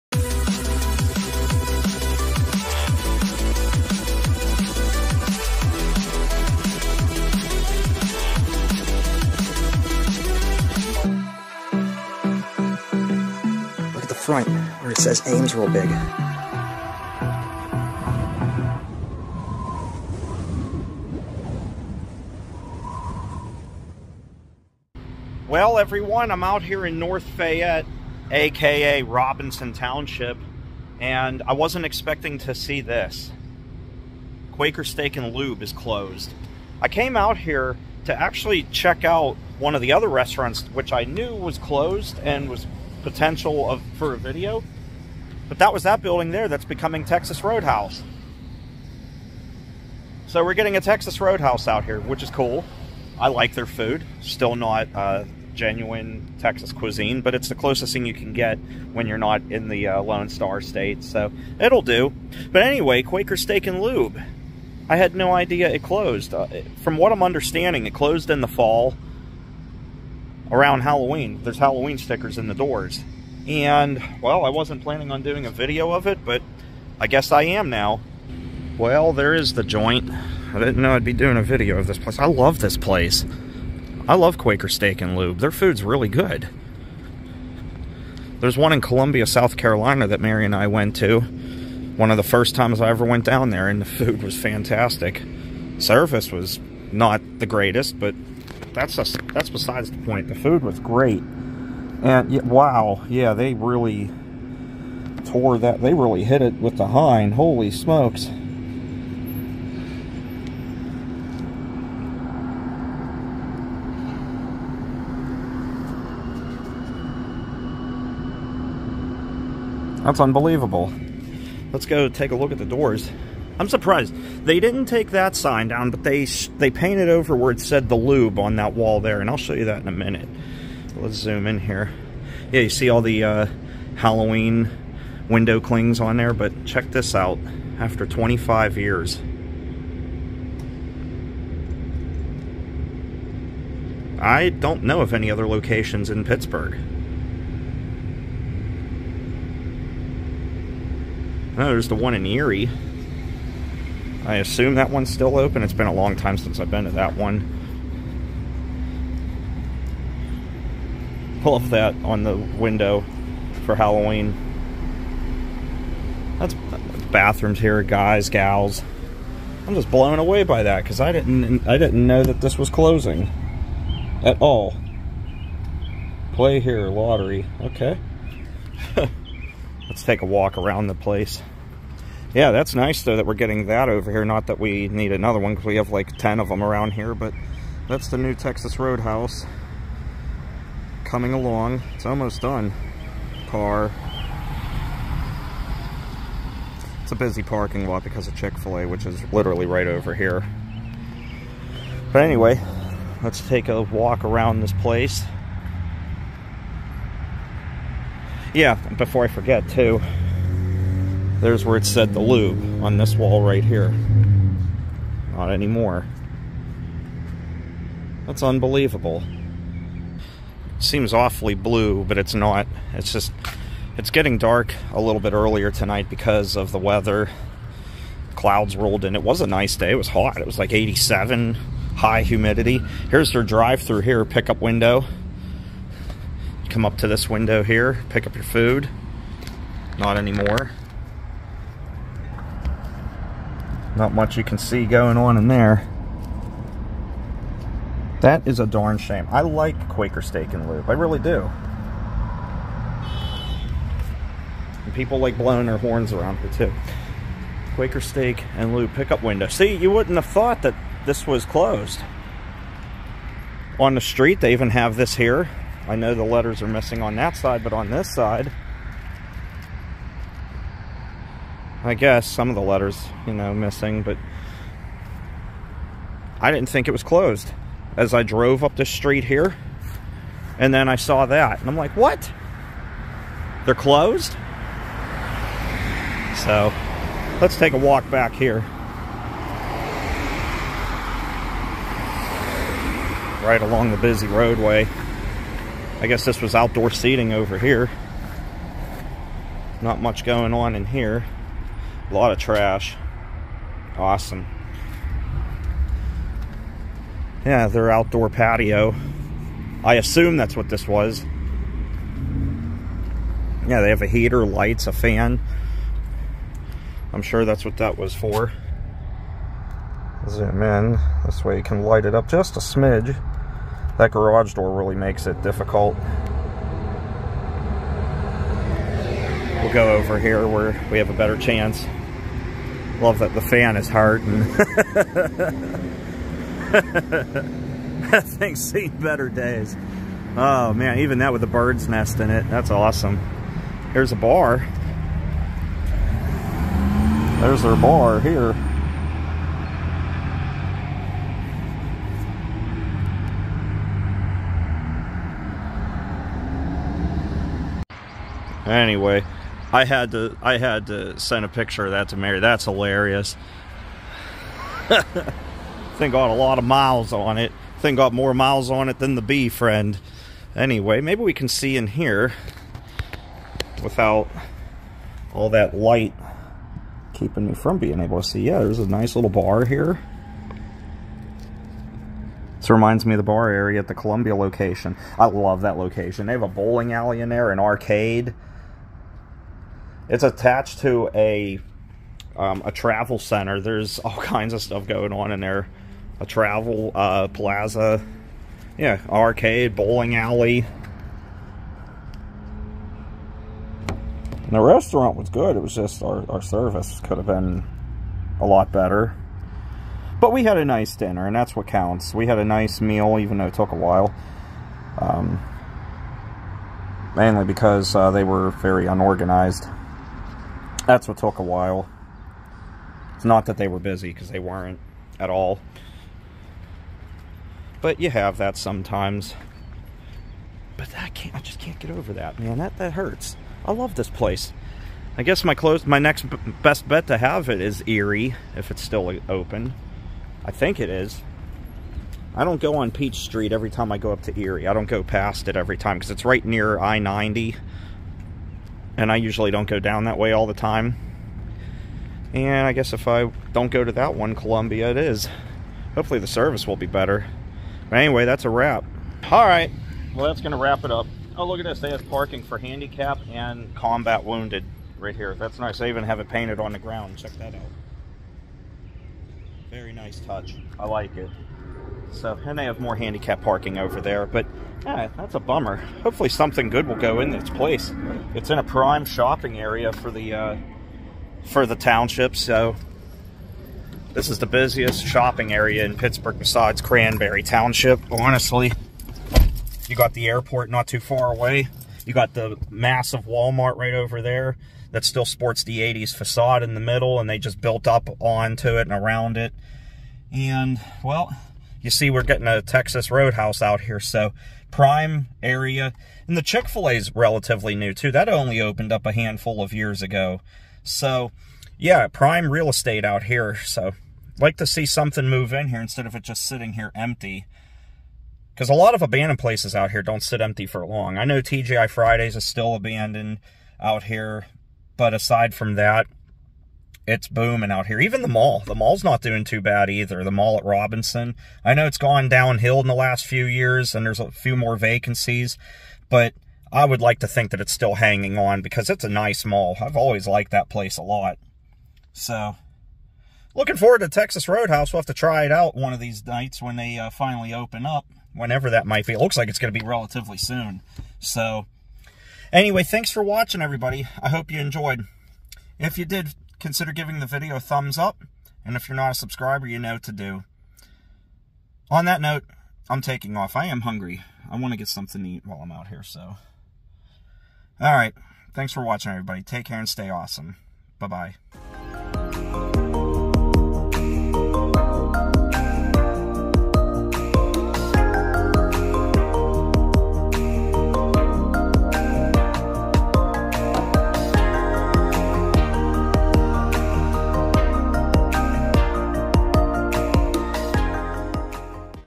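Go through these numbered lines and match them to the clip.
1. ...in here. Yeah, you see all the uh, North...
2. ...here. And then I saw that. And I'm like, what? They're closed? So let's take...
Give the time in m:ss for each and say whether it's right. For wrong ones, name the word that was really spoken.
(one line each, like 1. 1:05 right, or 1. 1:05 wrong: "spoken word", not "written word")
1. 2:11 wrong: "Halloween", not "North"
2. 4:39 right.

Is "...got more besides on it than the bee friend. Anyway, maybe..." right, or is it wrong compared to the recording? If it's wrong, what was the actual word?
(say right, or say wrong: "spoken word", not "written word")
wrong: "miles", not "besides".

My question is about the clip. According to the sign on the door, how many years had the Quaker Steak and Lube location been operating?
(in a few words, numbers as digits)
25.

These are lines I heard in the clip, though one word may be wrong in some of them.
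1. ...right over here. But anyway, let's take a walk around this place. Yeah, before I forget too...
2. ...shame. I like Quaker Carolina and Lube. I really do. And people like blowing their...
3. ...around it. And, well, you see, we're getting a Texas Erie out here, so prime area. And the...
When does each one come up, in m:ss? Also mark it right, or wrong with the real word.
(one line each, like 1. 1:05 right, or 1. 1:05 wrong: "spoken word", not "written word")
1. 3:19 right
2. 4:08 wrong: "Steak", not "Carolina"
3. 8:18 wrong: "Roadhouse", not "Erie".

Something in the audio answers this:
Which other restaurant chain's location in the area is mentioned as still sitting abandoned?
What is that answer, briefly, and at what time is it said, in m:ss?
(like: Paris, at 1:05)
TGI Fridays, at 8:41.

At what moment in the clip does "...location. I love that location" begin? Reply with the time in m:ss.
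6:24.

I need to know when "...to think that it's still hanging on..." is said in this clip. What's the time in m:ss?
8:57.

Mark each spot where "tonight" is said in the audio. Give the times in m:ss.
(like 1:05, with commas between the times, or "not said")
3:45.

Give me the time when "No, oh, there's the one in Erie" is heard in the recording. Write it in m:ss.
2:31.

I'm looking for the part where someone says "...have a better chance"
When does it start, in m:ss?
5:30.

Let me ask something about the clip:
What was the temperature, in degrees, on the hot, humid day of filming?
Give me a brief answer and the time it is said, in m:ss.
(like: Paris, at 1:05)
87, at 3:50.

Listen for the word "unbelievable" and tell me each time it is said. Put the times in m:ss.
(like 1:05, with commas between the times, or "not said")
2:00, 3:38.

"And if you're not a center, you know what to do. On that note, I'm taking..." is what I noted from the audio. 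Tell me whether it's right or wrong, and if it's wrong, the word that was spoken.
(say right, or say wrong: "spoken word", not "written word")
wrong: "subscriber", not "center".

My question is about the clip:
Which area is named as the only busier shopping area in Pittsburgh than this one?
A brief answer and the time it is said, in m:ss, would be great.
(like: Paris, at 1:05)
Cranberry Township, at 8:06.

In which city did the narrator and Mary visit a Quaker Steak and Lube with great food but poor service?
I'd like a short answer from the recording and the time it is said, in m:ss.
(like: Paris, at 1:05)
Columbia, South Carolina, at 1:28.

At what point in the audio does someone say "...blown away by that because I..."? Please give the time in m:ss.
2:49.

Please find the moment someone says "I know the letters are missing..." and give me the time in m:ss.
4:25.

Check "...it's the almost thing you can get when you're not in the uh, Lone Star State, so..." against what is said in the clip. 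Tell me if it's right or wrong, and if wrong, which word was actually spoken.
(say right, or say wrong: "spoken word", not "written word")
wrong: "closest", not "almost".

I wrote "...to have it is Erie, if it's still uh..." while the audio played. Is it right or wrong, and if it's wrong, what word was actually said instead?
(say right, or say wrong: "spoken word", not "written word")
right.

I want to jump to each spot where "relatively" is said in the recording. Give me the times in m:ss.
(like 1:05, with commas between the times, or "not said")
8:27, 9:09.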